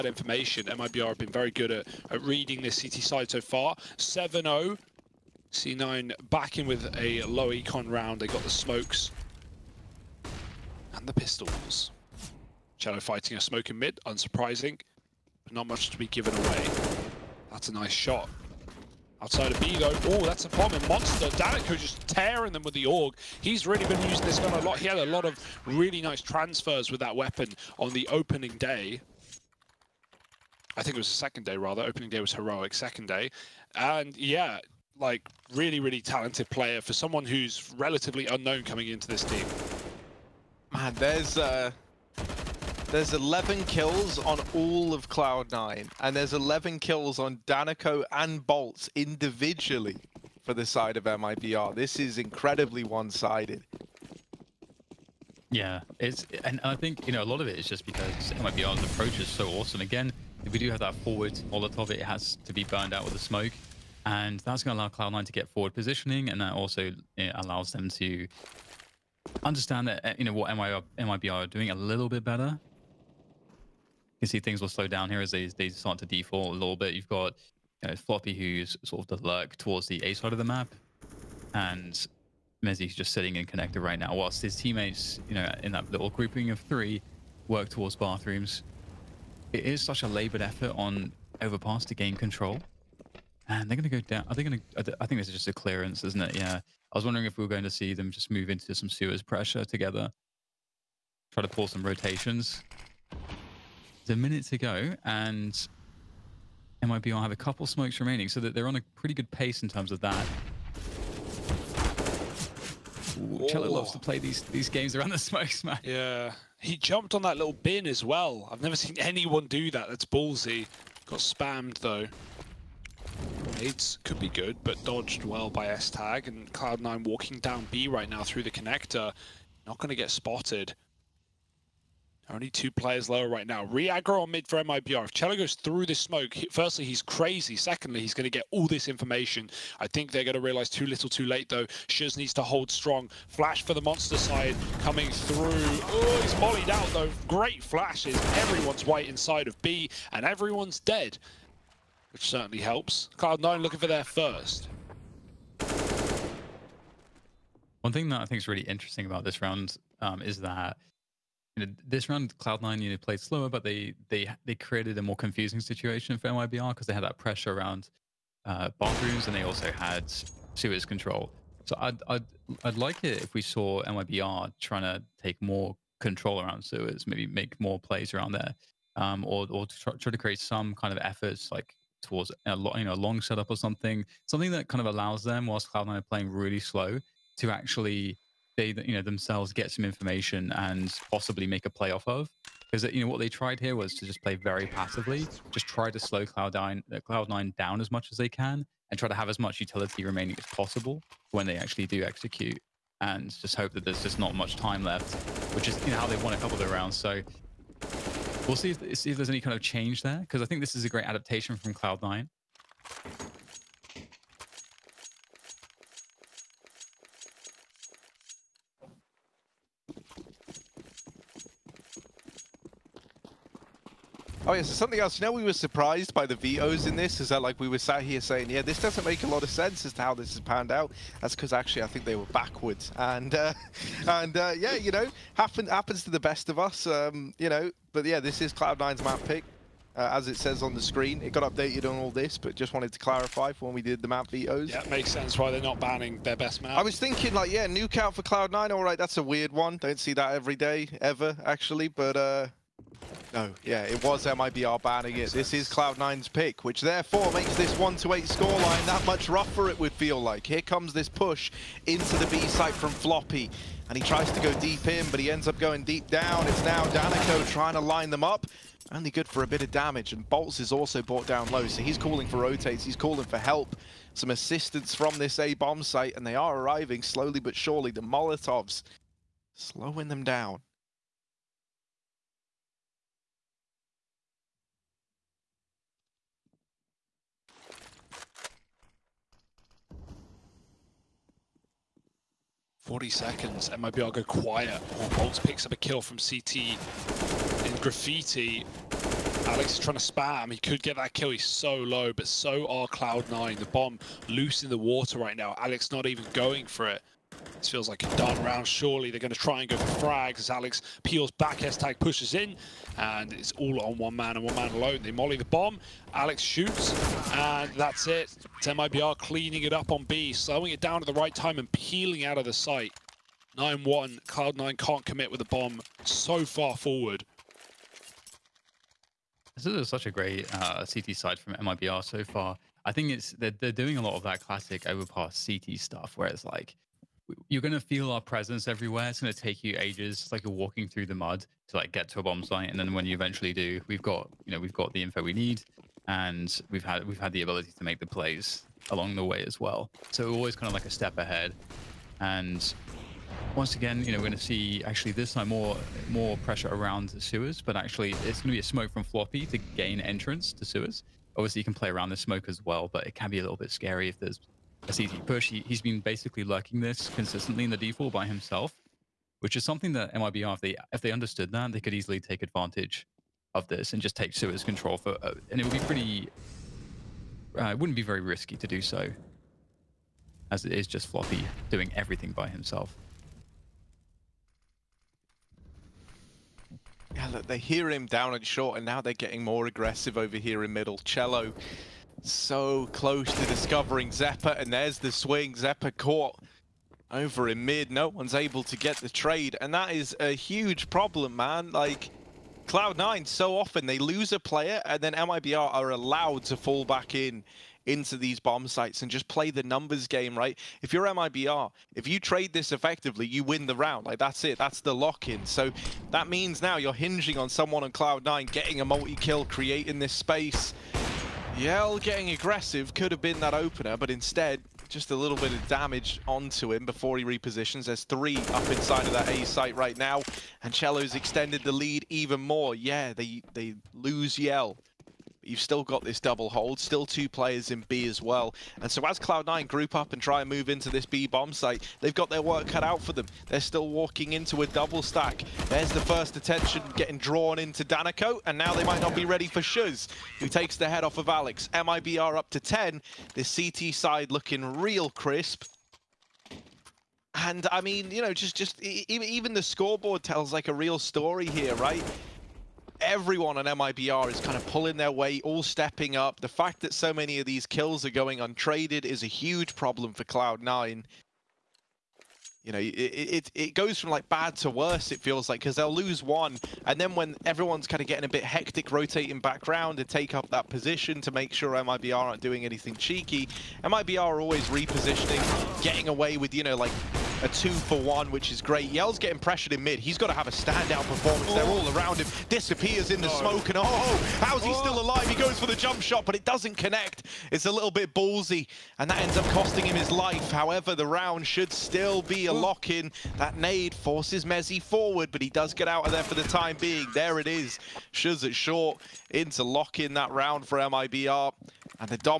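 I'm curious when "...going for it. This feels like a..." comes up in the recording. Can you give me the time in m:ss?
5:06.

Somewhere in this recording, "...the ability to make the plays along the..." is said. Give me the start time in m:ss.
5:47.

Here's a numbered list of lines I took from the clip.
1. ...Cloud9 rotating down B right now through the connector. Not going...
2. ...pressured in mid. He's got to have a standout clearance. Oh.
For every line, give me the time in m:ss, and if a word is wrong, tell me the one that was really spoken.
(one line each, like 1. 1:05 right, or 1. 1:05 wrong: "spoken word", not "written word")
1. 2:06 wrong: "walking", not "rotating"
2. 8:09 wrong: "performance", not "clearance".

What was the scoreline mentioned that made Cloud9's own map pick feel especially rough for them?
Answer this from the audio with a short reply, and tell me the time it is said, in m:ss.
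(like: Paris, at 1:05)
1-8, at 4:17.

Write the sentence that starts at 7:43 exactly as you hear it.
everyone on MIBR is kind of pulling their weight, all stepping up.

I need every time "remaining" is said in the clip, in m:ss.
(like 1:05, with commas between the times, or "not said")
1:48, 3:20.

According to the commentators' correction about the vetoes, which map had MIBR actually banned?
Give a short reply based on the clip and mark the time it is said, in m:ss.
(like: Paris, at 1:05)
Nuke, at 4:07.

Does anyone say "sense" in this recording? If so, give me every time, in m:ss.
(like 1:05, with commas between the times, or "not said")
3:49, 4:05.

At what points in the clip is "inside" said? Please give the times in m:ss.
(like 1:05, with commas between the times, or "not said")
2:29, 7:08.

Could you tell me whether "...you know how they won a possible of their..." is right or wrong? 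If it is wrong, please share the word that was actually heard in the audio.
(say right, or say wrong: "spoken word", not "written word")
wrong: "couple", not "possible".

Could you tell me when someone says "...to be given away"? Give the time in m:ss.
0:15.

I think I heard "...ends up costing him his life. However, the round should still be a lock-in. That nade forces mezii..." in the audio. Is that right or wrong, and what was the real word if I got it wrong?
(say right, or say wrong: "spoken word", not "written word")
right.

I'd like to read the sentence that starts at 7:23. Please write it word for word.
They're still walking into a double stack.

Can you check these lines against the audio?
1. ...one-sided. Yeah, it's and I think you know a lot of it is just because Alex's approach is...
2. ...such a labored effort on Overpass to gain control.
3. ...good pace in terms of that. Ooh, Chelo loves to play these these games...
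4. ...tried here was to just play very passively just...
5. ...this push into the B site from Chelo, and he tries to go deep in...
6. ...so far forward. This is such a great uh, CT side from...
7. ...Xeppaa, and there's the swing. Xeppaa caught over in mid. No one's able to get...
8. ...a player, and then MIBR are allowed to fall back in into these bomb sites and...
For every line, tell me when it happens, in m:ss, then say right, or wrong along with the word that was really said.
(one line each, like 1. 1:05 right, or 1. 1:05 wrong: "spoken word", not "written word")
1. 0:52 wrong: "MIBR", not "Alex"
2. 1:29 right
3. 1:49 right
4. 3:13 right
5. 4:20 wrong: "Floppy", not "Chelo"
6. 5:26 right
7. 6:34 right
8. 6:44 right.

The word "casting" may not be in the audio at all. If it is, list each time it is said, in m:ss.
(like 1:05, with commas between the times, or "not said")
not said.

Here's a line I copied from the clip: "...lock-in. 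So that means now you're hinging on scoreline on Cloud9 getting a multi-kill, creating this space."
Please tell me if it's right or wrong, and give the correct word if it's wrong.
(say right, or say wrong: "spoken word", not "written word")
wrong: "someone", not "scoreline".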